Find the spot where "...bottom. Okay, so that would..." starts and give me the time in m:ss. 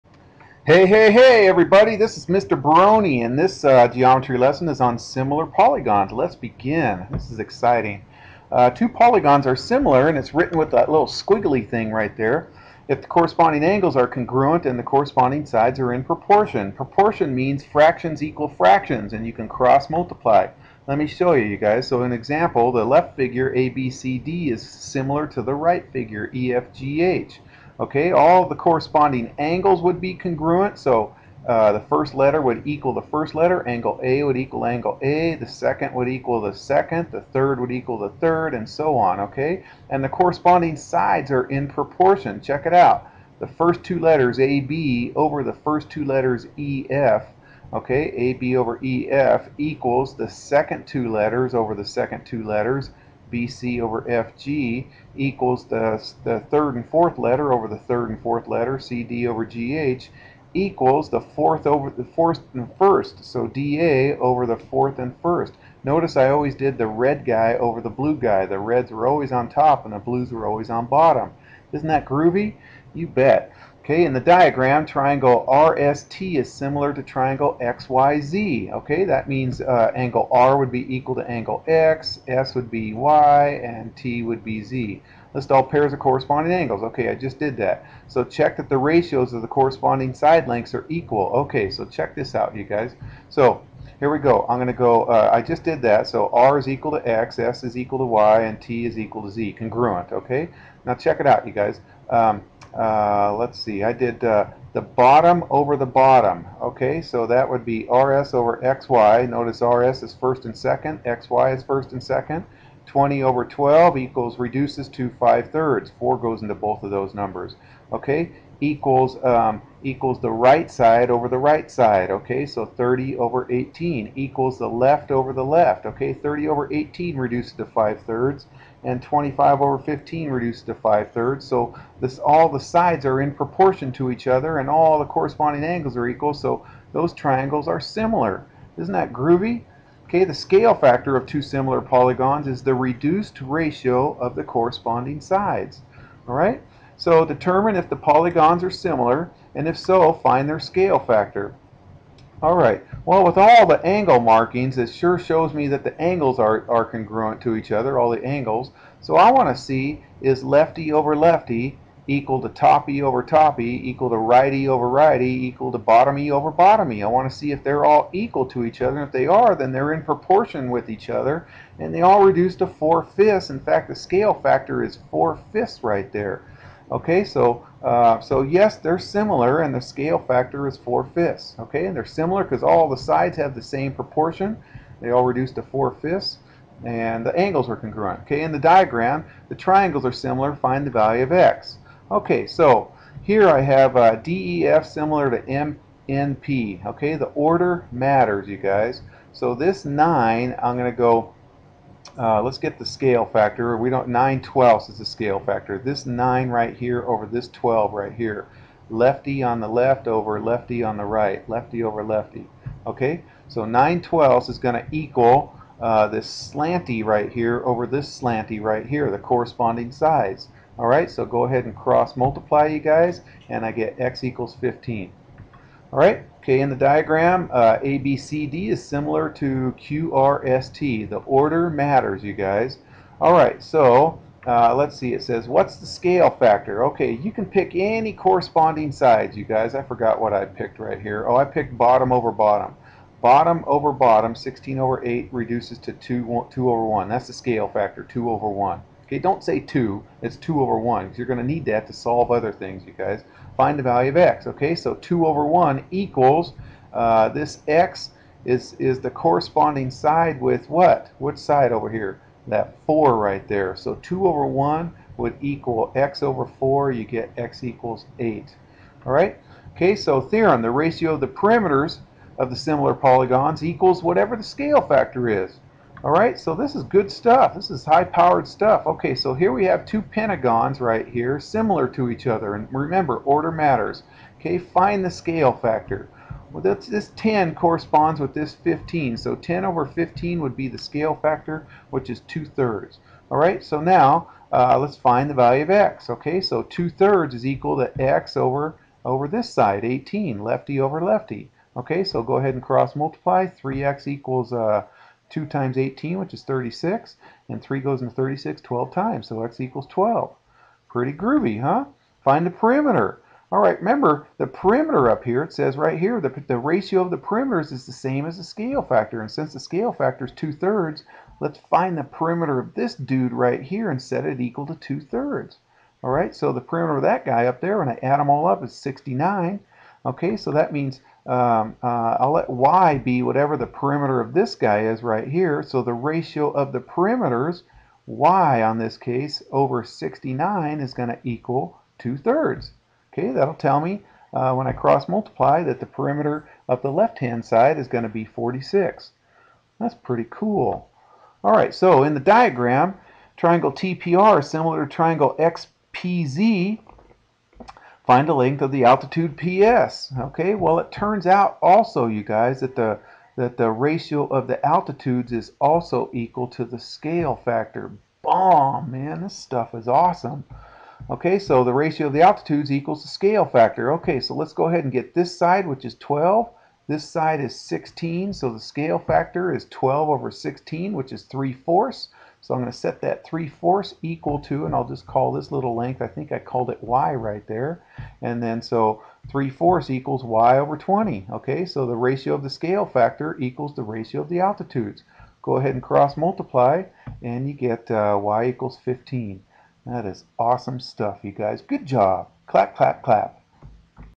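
1:45.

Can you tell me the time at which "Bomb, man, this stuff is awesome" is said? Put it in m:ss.
6:08.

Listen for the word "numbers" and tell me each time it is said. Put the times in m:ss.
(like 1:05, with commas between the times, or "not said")
1:57.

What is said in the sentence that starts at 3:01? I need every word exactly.
Okay, and they're similar because all the sides have the same proportion.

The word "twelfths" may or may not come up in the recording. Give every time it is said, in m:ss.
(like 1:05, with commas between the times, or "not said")
3:24, 3:34.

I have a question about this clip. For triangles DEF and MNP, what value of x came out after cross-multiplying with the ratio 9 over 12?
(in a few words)
15.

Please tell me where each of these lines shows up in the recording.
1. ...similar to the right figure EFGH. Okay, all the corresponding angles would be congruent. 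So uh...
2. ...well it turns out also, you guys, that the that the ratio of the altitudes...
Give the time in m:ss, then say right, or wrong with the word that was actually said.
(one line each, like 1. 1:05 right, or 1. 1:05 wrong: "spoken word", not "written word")
1. 0:24 right
2. 6:00 right.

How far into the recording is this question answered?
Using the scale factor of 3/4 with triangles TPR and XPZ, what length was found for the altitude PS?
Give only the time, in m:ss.
6:38.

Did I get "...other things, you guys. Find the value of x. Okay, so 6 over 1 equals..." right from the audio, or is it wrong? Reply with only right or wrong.
wrong.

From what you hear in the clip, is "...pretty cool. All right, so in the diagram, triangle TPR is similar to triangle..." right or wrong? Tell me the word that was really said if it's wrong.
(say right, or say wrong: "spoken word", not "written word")
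right.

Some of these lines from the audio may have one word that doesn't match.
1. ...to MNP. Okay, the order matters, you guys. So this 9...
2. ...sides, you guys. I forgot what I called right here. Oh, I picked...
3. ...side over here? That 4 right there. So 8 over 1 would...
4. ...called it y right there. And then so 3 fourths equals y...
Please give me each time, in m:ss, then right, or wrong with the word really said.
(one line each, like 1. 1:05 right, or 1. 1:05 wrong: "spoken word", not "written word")
1. 3:15 right
2. 3:58 wrong: "picked", not "called"
3. 4:21 wrong: "2", not "8"
4. 6:26 right.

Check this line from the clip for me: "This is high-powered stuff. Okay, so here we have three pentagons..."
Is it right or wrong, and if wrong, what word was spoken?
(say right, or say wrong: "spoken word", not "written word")
wrong: "two", not "three".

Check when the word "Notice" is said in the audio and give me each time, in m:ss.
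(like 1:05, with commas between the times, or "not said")
1:05, 1:49.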